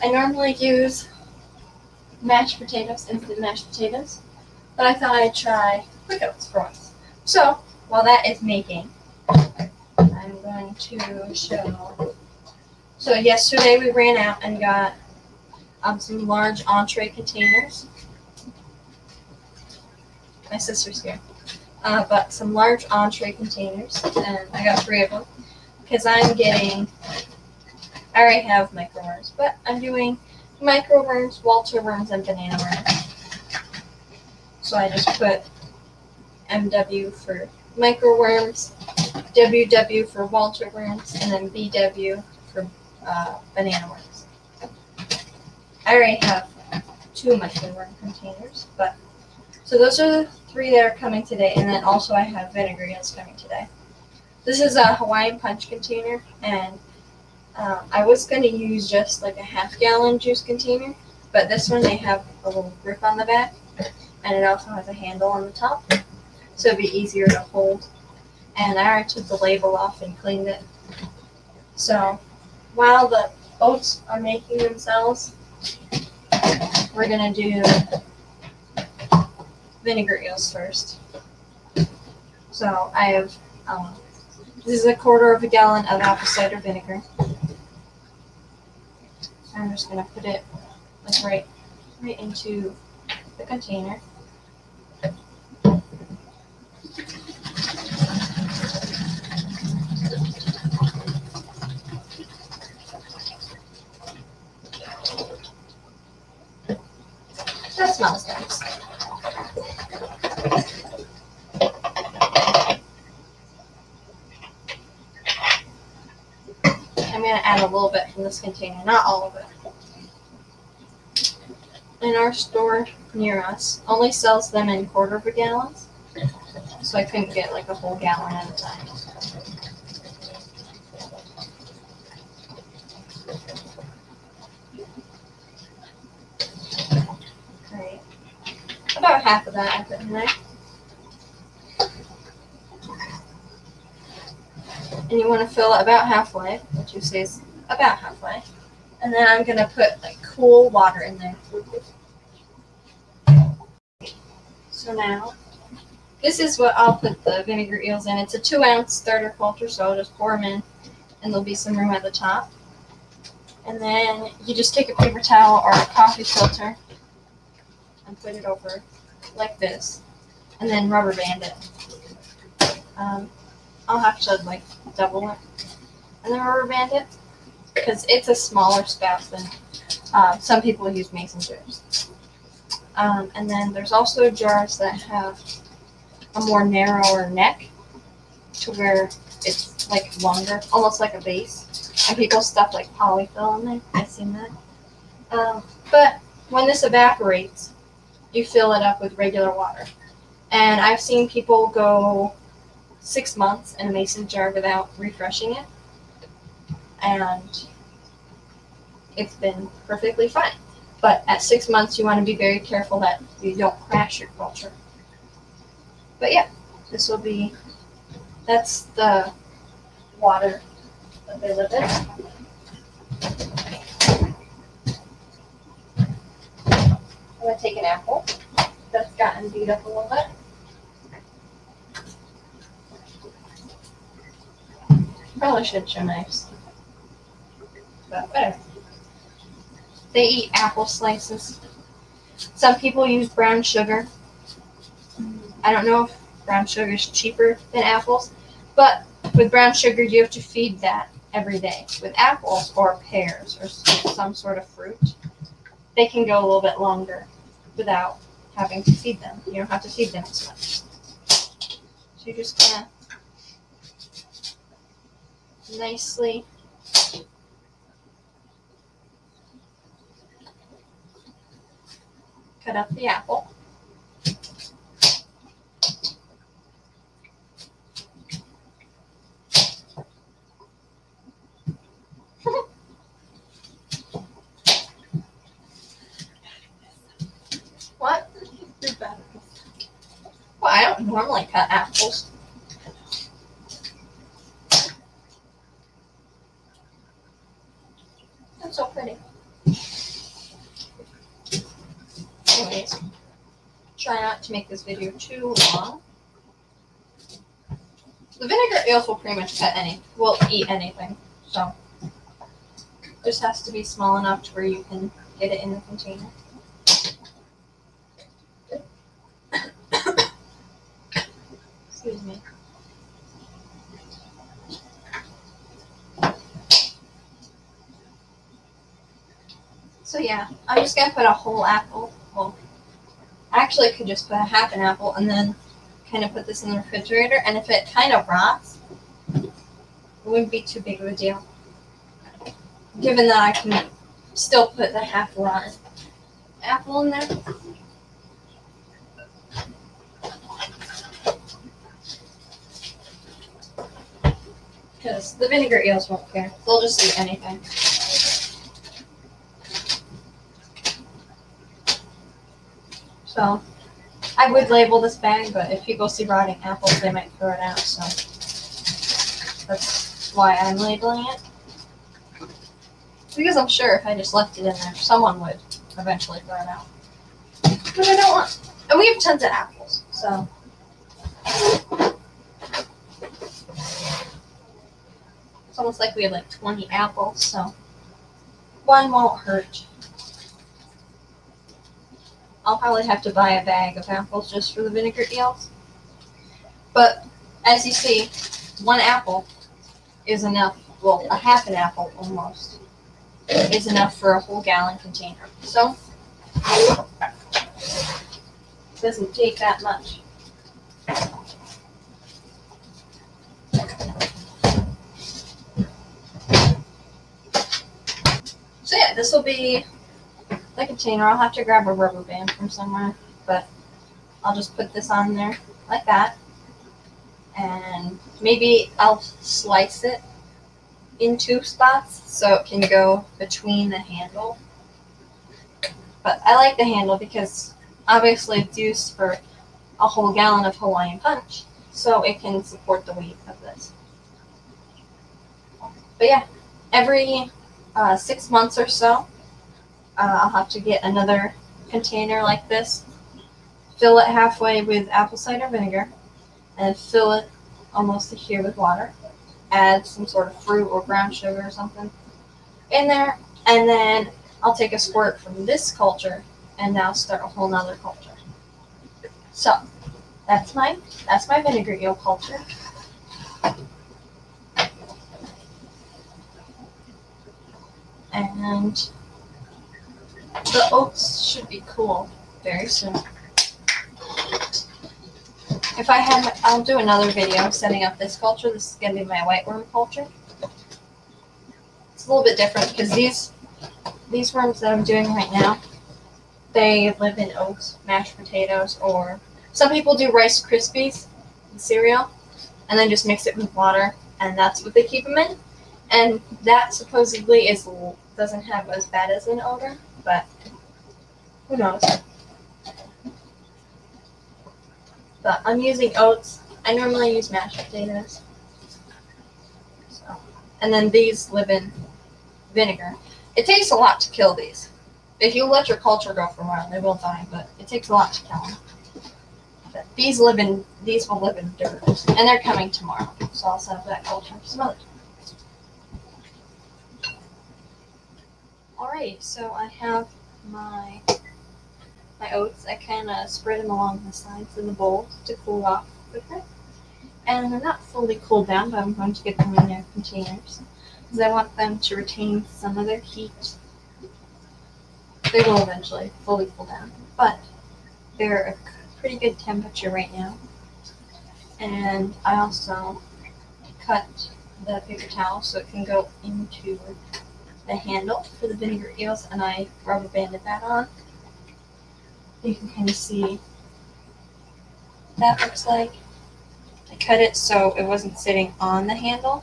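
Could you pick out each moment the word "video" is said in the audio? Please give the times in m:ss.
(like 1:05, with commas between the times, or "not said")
5:04, 8:07.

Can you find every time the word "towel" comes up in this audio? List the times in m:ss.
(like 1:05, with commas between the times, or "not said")
2:45, 9:25.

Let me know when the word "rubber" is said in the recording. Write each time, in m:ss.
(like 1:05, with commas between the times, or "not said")
2:50, 2:56, 7:01, 9:30.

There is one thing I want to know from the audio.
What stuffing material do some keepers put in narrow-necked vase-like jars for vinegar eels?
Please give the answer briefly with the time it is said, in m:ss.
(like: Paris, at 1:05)
polyfill, at 3:12.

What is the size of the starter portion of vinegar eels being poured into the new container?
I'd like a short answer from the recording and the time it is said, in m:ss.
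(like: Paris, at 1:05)
2 ounces, at 2:38.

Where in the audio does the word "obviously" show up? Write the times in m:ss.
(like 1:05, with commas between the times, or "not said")
7:18.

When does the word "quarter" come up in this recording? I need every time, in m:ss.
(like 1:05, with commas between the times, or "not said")
1:24, 2:04, 2:39.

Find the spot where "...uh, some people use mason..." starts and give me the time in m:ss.
3:00.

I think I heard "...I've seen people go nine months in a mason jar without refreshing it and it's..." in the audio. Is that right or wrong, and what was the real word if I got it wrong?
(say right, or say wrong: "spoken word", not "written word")
wrong: "six", not "nine".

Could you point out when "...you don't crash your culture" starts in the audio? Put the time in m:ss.
3:33.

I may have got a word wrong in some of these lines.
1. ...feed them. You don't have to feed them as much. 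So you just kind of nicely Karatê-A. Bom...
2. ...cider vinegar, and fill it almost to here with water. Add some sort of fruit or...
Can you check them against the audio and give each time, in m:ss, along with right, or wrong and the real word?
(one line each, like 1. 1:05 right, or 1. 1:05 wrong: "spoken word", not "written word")
1. 4:18 right
2. 7:35 right.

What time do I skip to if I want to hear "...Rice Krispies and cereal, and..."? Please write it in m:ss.
8:20.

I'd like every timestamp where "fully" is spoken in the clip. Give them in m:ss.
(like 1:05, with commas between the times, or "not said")
9:08, 9:16.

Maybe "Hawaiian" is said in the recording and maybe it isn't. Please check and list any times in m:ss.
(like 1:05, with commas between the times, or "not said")
0:54, 7:20.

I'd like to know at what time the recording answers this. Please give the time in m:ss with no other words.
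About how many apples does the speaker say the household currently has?
6:26.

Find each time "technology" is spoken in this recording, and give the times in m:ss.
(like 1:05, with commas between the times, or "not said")
not said.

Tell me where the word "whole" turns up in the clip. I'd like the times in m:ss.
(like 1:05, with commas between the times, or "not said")
2:07, 5:31, 6:44, 7:20, 7:47.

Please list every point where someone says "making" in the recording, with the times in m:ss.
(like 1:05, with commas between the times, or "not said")
0:08, 1:14.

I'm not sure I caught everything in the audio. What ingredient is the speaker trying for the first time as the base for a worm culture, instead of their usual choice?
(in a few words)
quick oats.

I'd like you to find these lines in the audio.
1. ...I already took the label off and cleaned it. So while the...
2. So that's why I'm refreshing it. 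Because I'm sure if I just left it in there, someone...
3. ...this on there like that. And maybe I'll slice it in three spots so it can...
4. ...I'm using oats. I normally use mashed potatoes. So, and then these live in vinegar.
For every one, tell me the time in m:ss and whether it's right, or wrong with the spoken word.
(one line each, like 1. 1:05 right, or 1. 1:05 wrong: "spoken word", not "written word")
1. 1:08 right
2. 6:07 wrong: "labeling", not "refreshing"
3. 7:04 wrong: "two", not "three"
4. 8:35 right.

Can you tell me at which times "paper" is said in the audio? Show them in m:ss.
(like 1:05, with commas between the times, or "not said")
2:44, 9:25.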